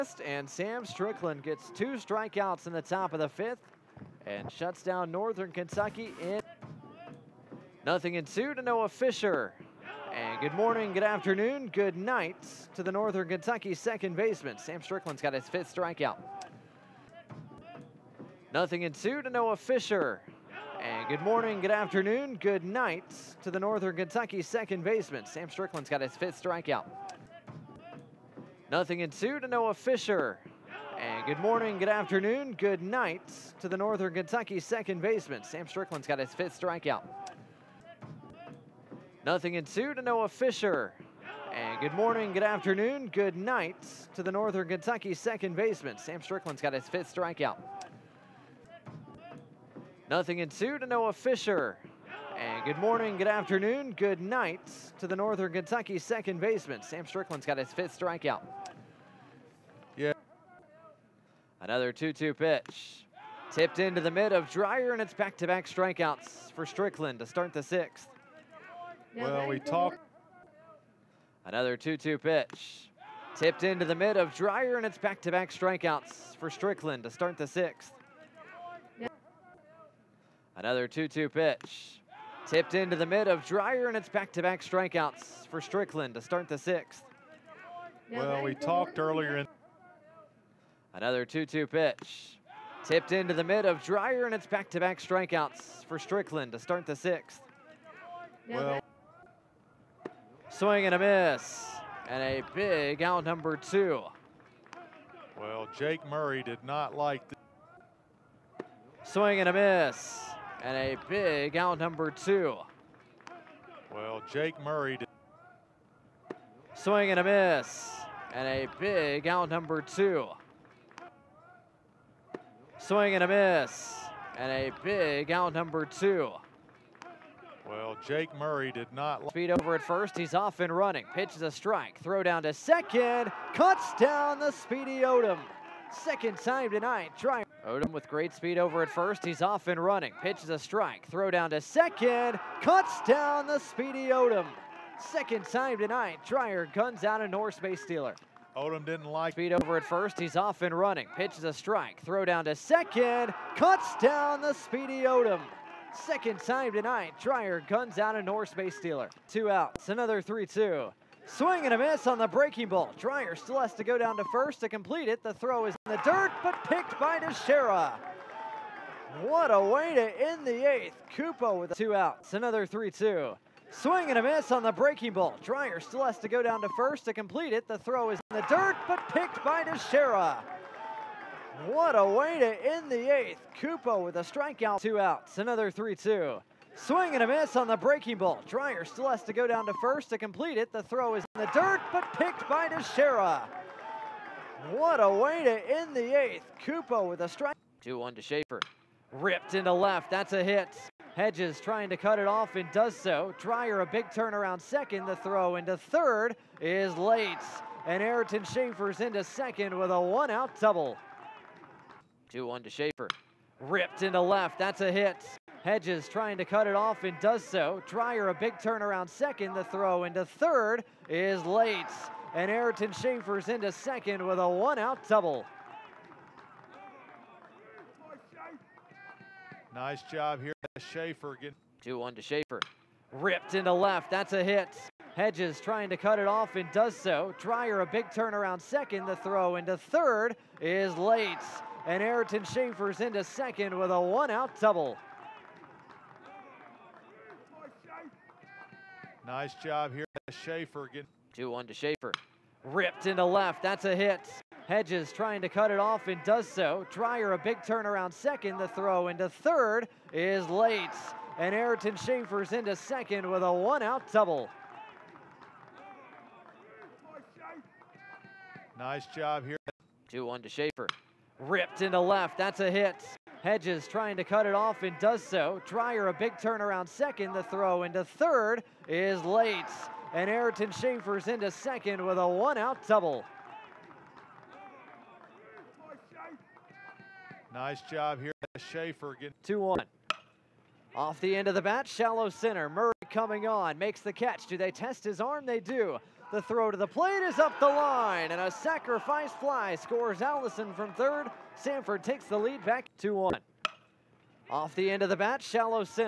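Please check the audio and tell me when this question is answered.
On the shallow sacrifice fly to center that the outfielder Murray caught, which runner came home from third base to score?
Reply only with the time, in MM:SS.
05:00.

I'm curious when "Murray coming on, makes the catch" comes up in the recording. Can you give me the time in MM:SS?
04:52.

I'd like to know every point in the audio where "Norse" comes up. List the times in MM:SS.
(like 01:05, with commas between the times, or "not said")
02:27, 02:38.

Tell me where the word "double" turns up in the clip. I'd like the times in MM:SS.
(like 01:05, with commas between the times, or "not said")
03:30, 03:45, 04:04, 04:24, 04:42.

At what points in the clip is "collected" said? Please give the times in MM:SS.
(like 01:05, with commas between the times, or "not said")
not said.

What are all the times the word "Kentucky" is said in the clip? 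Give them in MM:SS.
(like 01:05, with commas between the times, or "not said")
00:05, 00:13, 00:23, 00:34, 00:44, 00:55.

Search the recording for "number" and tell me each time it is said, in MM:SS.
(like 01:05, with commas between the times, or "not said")
01:43, 01:51, 01:59, 02:05.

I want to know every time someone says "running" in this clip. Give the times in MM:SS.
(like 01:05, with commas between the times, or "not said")
02:10, 02:19, 02:30.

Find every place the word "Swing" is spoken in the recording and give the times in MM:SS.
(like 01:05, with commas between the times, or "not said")
01:40, 01:49, 01:56, 02:02, 02:41, 02:53, 03:06.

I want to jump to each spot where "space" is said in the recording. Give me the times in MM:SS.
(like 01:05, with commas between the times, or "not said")
02:27, 02:38.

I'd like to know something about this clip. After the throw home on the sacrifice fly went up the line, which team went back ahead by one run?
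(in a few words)
Samford.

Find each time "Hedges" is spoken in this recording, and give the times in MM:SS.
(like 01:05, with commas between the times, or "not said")
03:21, 03:35, 03:55, 04:14, 04:33.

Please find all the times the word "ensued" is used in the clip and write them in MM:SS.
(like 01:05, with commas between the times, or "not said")
00:08, 00:50.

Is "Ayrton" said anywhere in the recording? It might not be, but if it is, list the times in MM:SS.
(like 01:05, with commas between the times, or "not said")
03:28, 03:42, 04:02, 04:21, 04:40.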